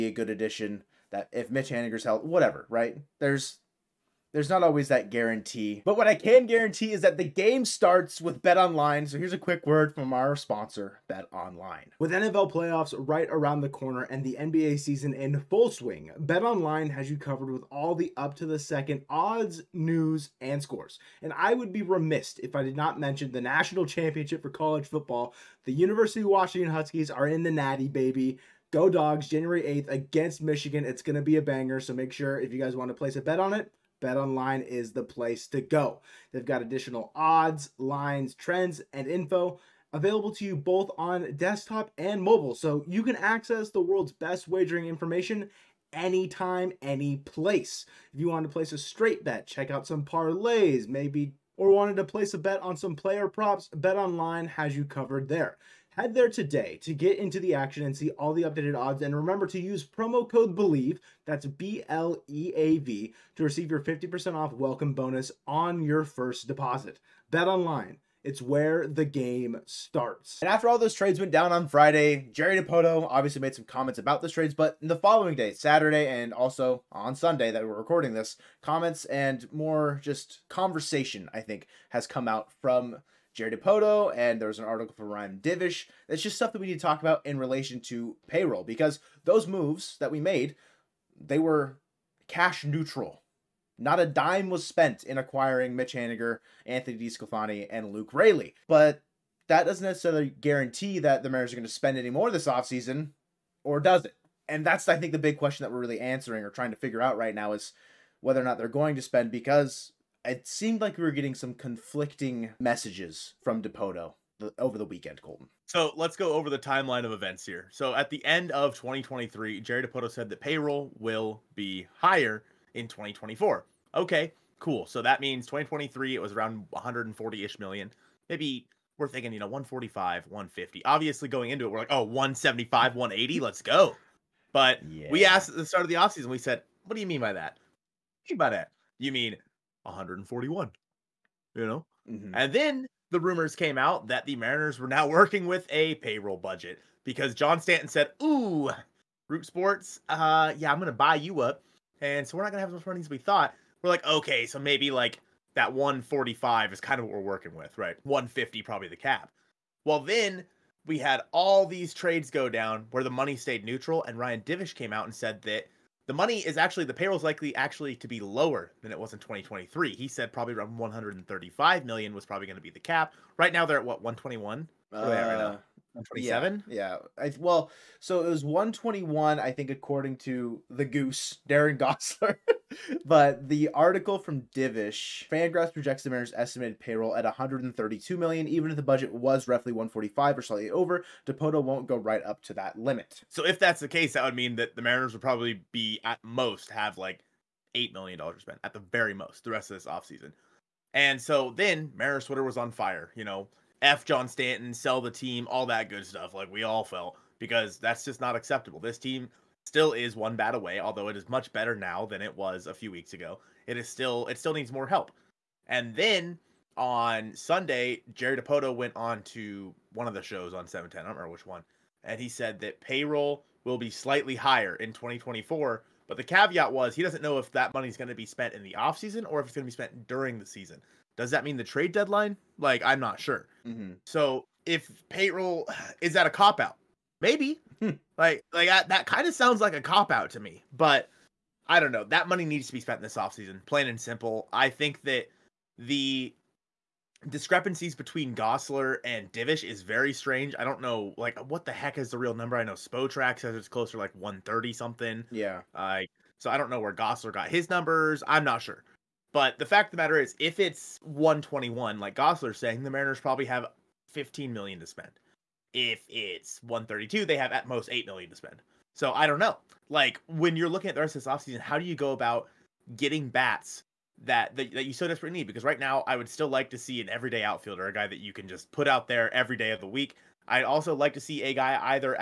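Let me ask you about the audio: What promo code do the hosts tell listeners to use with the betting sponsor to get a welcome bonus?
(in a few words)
BLEAV.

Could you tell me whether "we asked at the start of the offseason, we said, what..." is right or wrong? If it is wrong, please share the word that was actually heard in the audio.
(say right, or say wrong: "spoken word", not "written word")
right.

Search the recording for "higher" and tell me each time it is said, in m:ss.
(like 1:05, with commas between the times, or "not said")
2:02, 3:44.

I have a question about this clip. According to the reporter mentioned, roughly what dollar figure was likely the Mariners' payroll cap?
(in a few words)
135 million.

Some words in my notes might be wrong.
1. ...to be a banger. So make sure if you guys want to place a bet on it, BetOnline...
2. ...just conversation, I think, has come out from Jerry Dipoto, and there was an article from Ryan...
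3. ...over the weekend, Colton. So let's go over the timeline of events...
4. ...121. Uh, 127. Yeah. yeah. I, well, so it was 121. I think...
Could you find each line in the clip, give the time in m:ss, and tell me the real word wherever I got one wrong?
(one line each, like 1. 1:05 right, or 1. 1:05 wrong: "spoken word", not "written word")
1. 0:31 right
2. 1:20 right
3. 1:54 right
4. 2:54 right.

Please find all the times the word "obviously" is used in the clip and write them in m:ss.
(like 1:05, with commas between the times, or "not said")
1:13, 2:10.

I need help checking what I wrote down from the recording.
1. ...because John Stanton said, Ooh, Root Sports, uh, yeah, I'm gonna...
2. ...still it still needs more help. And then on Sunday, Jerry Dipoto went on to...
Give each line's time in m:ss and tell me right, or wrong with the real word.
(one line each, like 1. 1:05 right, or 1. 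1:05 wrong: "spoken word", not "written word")
1. 2:27 right
2. 3:33 right.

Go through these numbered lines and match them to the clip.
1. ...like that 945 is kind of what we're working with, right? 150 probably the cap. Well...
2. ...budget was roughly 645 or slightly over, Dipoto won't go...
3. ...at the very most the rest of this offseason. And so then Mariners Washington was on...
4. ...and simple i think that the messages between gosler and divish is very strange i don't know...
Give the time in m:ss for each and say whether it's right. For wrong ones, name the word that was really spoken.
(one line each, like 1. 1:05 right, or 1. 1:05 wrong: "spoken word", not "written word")
1. 2:34 wrong: "145", not "945"
2. 3:08 wrong: "145", not "645"
3. 3:18 wrong: "Twitter", not "Washington"
4. 4:03 wrong: "discrepancies", not "messages".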